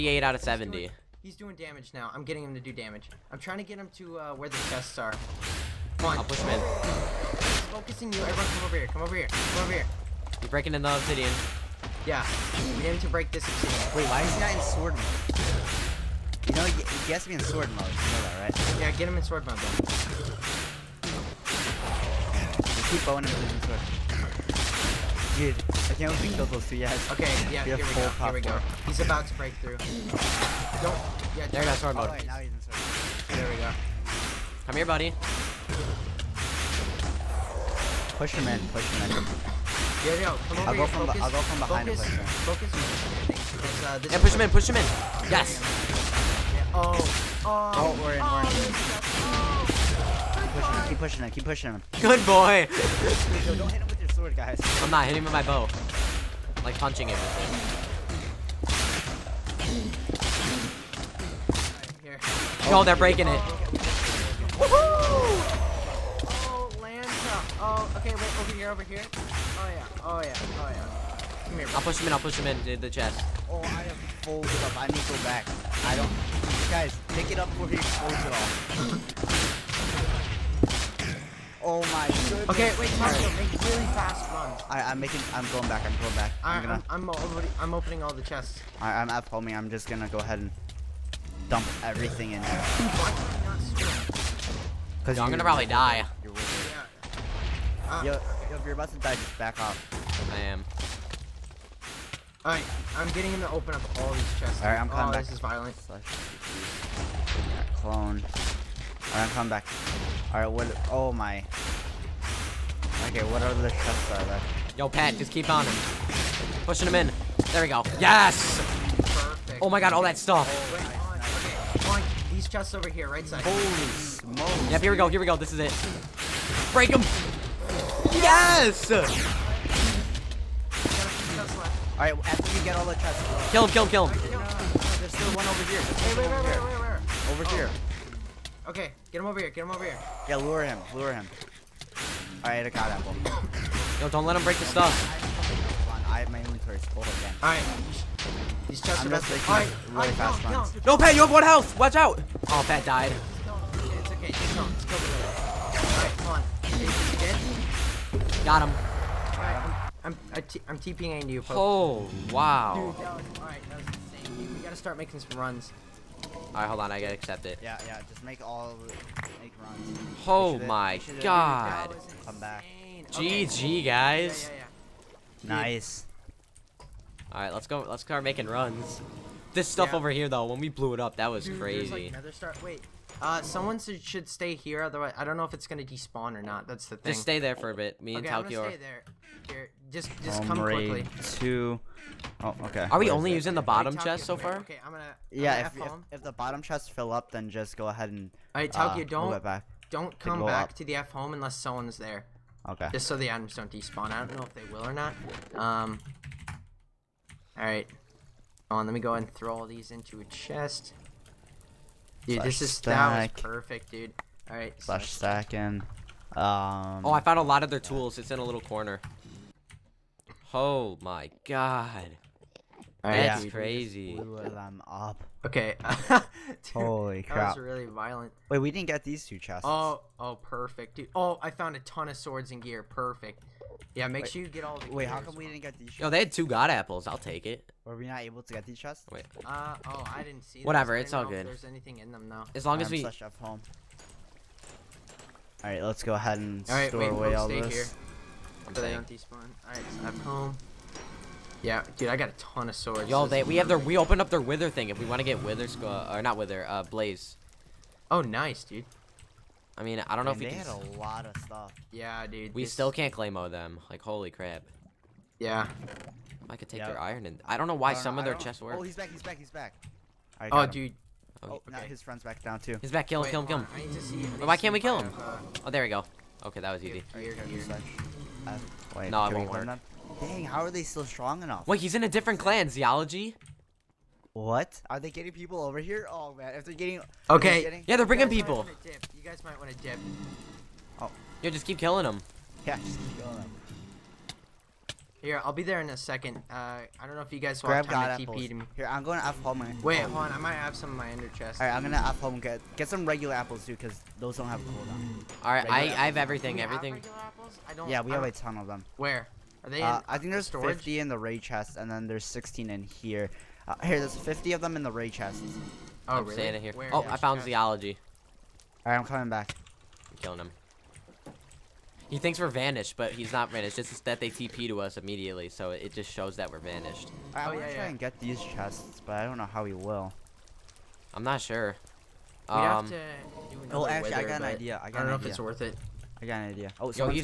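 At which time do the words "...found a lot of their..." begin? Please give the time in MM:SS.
03:37.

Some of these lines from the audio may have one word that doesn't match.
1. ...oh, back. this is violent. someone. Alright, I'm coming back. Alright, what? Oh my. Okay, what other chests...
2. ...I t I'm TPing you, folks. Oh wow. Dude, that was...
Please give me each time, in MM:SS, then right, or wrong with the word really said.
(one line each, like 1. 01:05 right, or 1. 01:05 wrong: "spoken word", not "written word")
1. 01:45 wrong: "clone", not "someone"
2. 02:40 right.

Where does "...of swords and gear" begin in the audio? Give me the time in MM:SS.
03:52.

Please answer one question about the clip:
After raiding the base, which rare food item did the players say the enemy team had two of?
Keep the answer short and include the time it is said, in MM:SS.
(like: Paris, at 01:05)
God apples, at 03:56.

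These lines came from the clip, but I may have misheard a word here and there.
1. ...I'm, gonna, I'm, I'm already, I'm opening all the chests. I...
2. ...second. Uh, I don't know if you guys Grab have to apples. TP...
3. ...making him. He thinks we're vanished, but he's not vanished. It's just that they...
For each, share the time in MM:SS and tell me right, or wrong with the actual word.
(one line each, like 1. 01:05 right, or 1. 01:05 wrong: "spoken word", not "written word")
1. 01:26 right
2. 04:55 right
3. 05:20 wrong: "killing", not "making".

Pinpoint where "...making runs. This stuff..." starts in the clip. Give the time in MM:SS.
02:58.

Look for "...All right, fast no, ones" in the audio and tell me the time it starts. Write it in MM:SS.
02:29.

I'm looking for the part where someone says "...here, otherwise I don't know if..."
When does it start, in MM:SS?
03:04.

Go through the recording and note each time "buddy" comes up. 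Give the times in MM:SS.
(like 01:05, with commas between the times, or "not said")
00:34.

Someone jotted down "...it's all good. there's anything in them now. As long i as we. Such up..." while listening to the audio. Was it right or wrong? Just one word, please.
right.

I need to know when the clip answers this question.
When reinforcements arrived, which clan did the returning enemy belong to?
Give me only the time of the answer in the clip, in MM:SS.
04:42.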